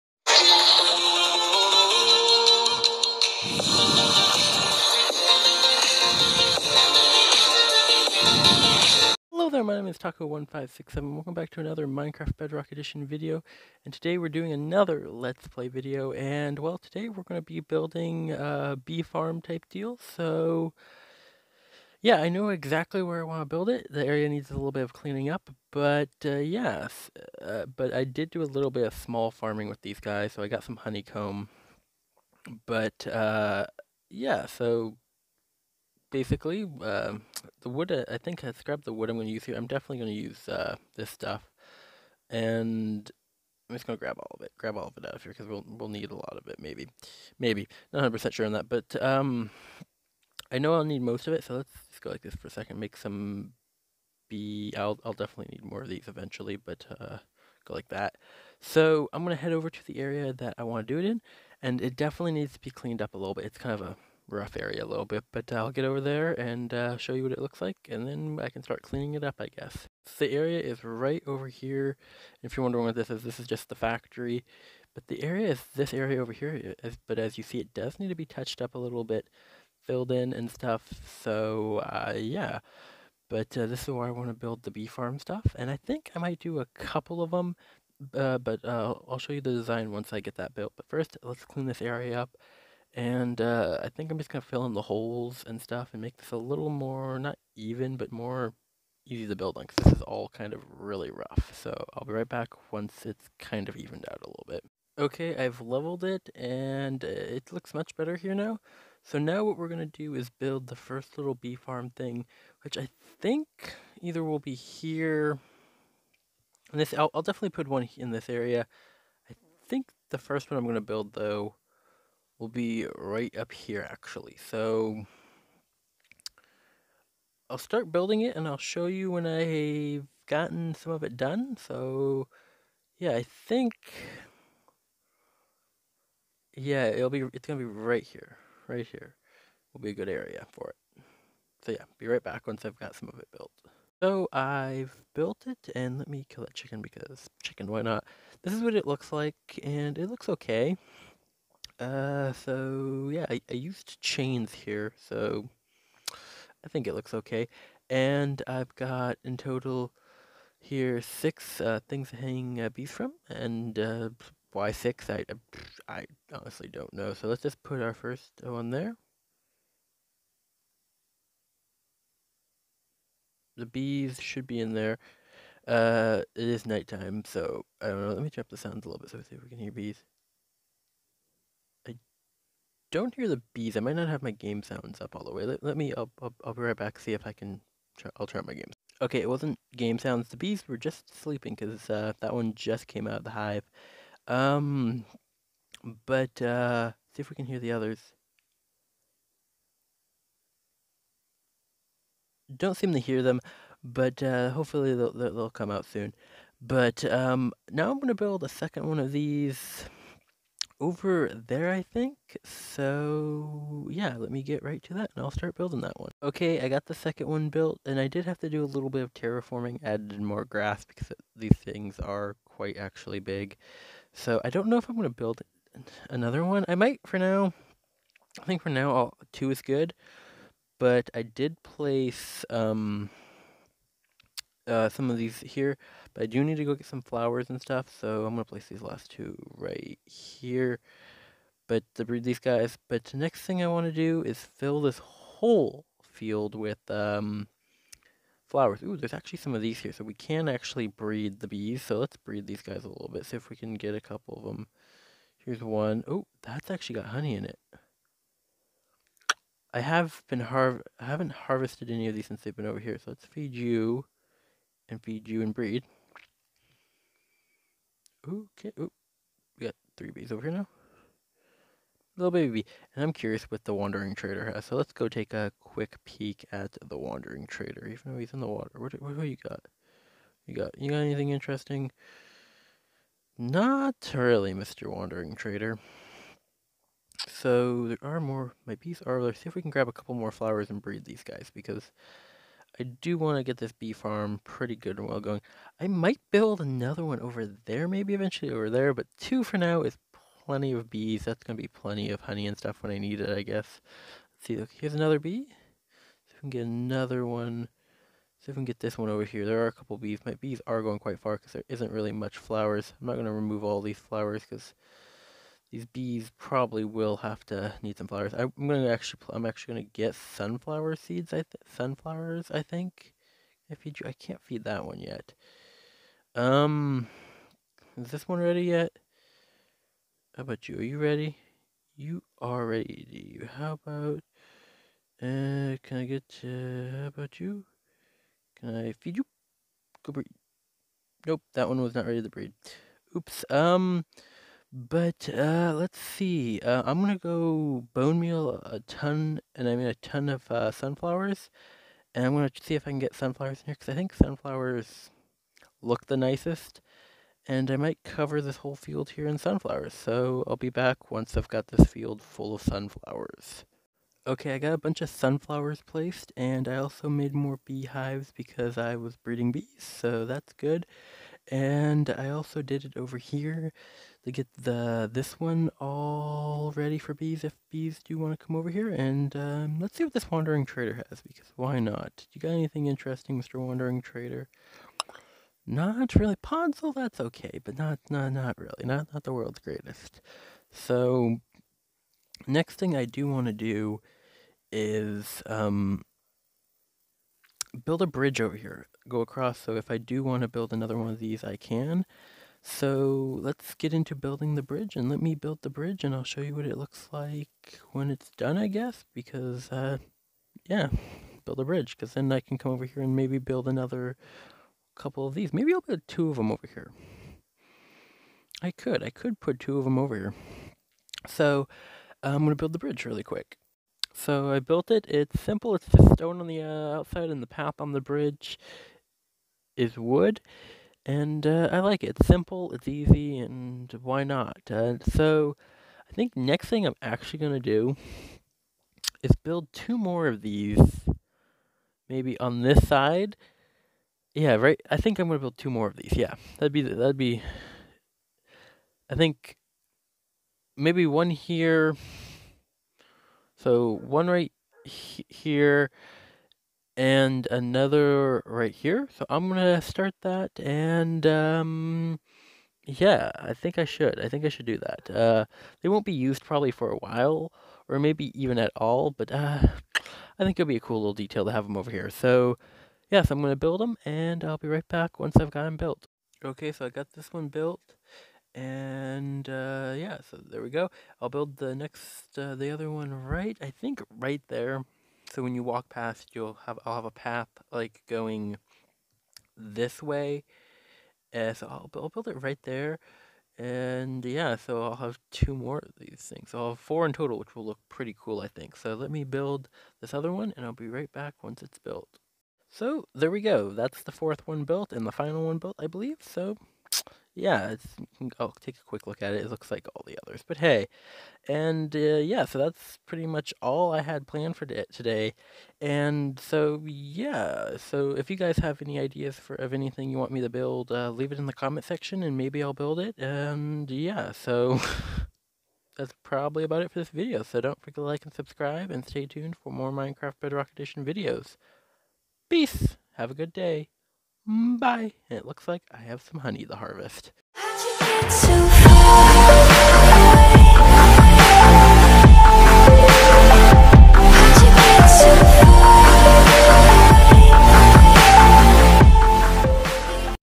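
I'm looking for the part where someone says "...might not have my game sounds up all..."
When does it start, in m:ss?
3:03.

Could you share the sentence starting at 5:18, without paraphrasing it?
I'm gonna actually, I'm actually gonna get sunflower seeds.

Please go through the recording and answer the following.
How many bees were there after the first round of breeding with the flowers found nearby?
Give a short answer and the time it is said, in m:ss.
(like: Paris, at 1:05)
3, at 4:29.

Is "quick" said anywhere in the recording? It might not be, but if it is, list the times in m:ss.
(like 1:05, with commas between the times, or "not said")
4:35, 7:03, 8:28.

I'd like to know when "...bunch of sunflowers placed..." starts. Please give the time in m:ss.
6:04.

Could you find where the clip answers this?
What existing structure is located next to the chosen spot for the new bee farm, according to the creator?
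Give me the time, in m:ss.
1:13.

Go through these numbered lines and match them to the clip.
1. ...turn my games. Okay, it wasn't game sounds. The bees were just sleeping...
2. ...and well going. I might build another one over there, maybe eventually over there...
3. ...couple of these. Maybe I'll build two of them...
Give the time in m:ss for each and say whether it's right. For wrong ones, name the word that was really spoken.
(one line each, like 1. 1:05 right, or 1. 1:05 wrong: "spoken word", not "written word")
1. 3:08 right
2. 4:54 right
3. 6:54 right.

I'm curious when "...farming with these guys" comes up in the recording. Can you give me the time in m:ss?
0:29.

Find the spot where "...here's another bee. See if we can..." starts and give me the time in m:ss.
5:04.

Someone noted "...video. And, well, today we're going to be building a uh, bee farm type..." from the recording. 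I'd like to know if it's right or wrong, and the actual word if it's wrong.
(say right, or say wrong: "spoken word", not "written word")
right.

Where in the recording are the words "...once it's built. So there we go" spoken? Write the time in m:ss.
8:21.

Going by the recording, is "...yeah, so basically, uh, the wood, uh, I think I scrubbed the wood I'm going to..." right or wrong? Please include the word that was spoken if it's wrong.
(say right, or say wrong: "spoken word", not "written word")
right.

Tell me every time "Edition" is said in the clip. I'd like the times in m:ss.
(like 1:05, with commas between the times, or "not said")
0:12, 8:50.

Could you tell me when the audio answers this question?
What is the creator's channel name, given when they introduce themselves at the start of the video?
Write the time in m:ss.
0:09.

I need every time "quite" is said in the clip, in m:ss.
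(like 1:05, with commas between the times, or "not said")
3:42, 5:10.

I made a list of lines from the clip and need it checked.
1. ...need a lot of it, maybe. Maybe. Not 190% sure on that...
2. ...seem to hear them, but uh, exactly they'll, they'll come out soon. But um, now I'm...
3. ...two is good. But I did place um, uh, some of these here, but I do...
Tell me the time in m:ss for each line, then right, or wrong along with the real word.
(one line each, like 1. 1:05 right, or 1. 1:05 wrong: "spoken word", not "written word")
1. 0:45 wrong: "100", not "190"
2. 3:22 wrong: "hopefully", not "exactly"
3. 3:49 right.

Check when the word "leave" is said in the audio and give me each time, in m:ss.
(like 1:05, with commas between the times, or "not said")
8:41.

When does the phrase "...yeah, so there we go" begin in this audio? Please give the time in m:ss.
7:59.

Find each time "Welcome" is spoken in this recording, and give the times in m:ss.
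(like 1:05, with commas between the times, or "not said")
0:11.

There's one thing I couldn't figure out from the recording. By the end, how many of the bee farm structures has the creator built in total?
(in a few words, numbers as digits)
4.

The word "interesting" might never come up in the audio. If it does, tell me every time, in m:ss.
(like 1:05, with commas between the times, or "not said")
4:41, 6:22.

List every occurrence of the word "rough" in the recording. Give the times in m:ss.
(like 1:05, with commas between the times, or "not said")
1:04, 1:41.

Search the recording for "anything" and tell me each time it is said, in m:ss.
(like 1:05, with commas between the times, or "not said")
4:40, 6:22, 8:39.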